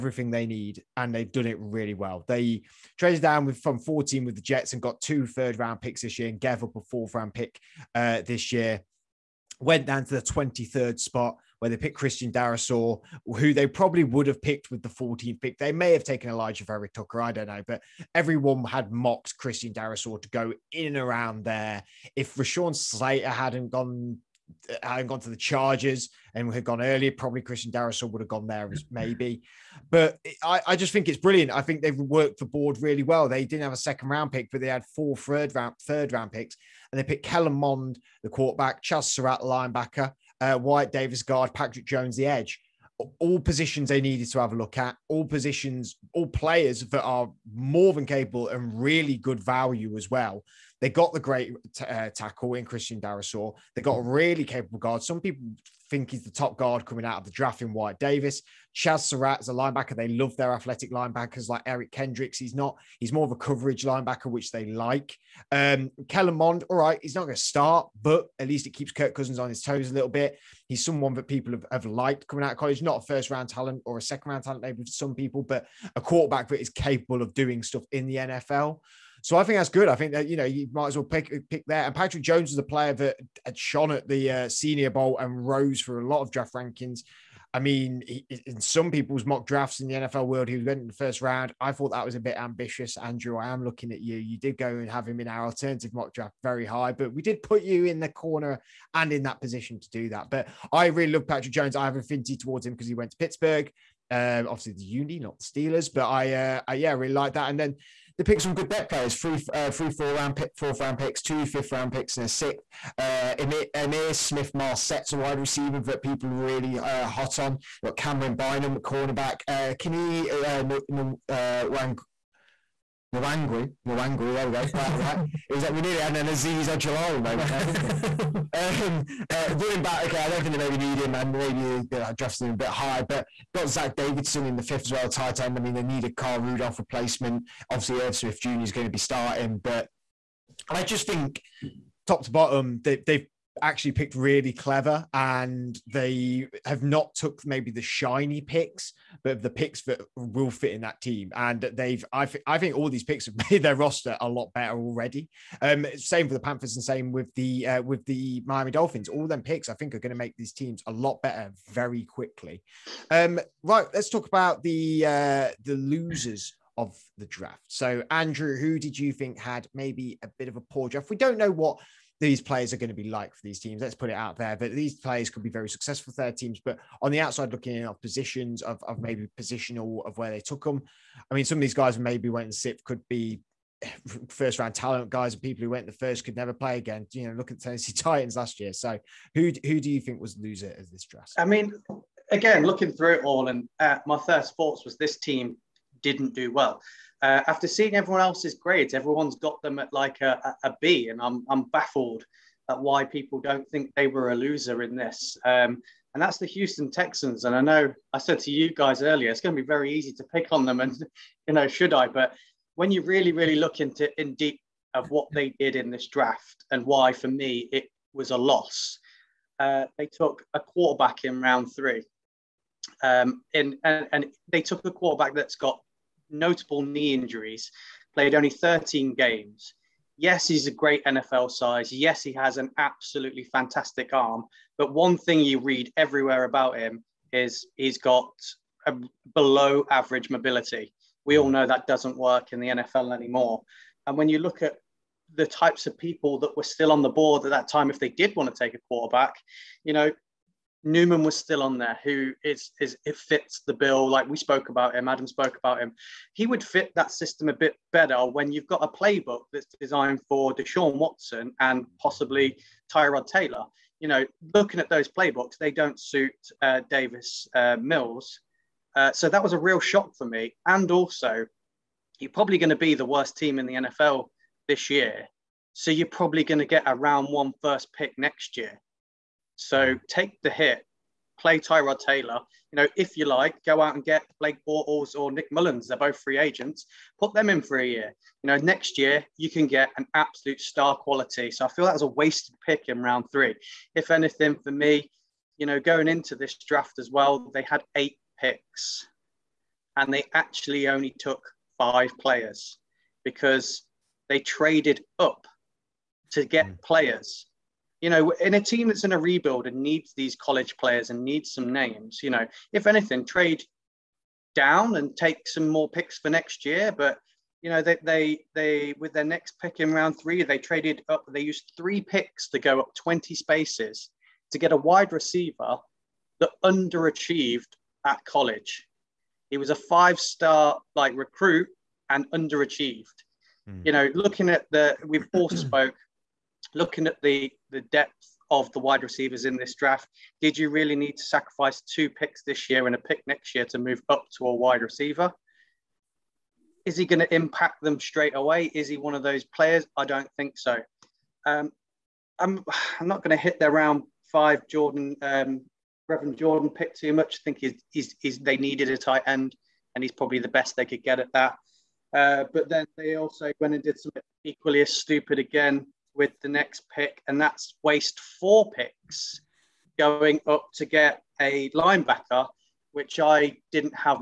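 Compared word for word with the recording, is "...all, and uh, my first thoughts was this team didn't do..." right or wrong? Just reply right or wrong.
right.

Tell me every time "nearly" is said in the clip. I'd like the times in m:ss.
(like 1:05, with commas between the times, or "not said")
2:05.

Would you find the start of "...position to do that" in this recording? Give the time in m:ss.
1:39.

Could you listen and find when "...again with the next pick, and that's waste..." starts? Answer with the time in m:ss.
6:05.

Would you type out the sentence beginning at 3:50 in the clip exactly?
Yes, he's a great NFL size.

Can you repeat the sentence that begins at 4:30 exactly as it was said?
And also, you're probably going to be the worst team in the NFL this year.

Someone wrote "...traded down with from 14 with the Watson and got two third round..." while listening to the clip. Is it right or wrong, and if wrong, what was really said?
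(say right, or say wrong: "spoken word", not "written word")
wrong: "Jets", not "Watson".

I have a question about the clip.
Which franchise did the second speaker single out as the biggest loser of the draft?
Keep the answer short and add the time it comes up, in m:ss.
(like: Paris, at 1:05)
Houston Texans, at 3:26.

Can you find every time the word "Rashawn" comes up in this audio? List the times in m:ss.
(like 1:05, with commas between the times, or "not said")
0:22.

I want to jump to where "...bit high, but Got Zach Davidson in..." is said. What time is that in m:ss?
2:12.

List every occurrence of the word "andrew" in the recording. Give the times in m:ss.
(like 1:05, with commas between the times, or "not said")
1:32, 2:48.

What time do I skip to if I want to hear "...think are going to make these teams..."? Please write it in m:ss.
2:39.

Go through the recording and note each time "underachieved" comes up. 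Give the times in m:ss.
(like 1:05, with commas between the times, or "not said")
5:26, 5:32.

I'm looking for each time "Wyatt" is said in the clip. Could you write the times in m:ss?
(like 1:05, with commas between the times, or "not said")
0:40, 0:57.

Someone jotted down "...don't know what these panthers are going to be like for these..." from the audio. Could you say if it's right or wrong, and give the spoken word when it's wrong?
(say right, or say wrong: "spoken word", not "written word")
wrong: "players", not "panthers".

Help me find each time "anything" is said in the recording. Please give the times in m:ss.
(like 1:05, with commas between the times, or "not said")
4:54, 5:12.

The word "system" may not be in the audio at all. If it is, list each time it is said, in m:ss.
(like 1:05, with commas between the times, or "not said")
4:17.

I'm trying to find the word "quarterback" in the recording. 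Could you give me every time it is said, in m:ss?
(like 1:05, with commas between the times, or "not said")
0:38, 1:15, 3:40, 3:44, 4:08.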